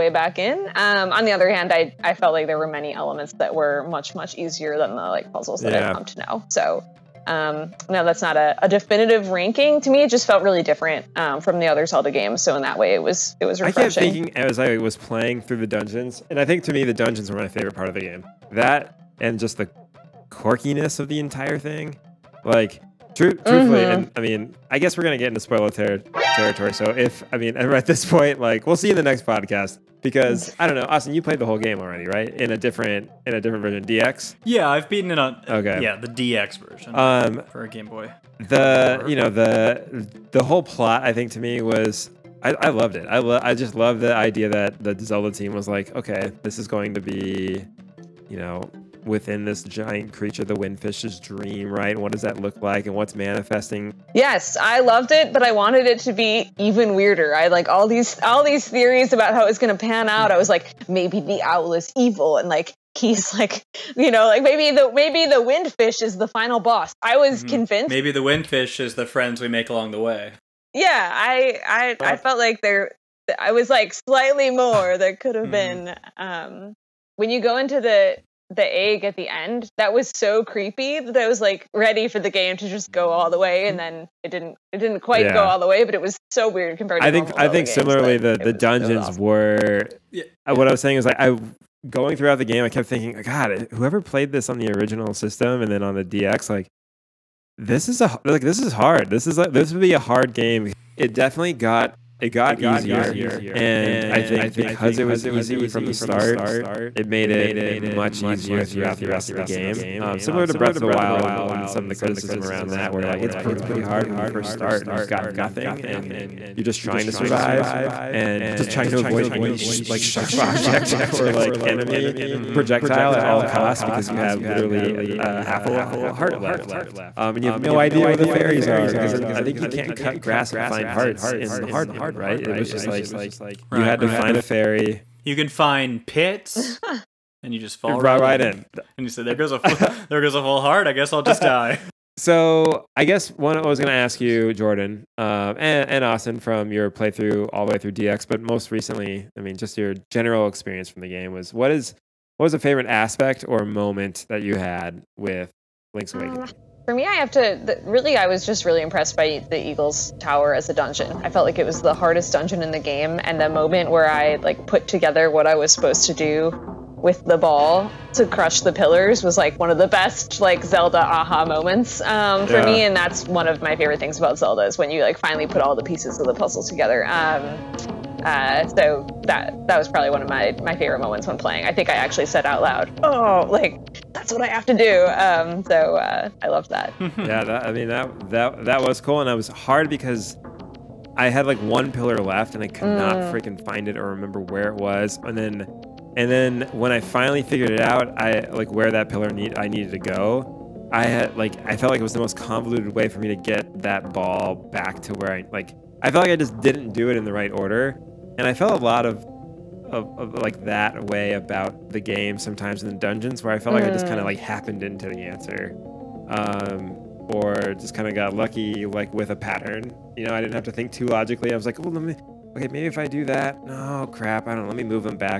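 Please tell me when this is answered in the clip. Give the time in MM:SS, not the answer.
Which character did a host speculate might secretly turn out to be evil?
01:01.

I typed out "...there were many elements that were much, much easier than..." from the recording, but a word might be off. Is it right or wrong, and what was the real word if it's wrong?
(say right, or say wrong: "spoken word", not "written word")
right.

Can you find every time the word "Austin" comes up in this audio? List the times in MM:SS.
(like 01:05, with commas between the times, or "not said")
00:30, 02:26.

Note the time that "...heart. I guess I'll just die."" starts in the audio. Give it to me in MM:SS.
02:20.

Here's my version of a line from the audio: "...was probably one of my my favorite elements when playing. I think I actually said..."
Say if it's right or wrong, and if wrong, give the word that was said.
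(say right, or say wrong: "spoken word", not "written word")
wrong: "moments", not "elements".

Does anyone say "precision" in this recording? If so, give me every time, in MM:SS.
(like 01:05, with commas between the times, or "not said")
not said.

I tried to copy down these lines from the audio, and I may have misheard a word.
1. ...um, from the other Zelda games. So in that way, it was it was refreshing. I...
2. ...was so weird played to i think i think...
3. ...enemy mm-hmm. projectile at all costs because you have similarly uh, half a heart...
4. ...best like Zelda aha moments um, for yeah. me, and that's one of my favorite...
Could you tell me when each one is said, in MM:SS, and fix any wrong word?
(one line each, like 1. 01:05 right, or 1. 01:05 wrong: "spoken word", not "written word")
1. 00:11 right
2. 01:26 wrong: "compared", not "played"
3. 02:01 wrong: "literally", not "similarly"
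4. 02:49 right.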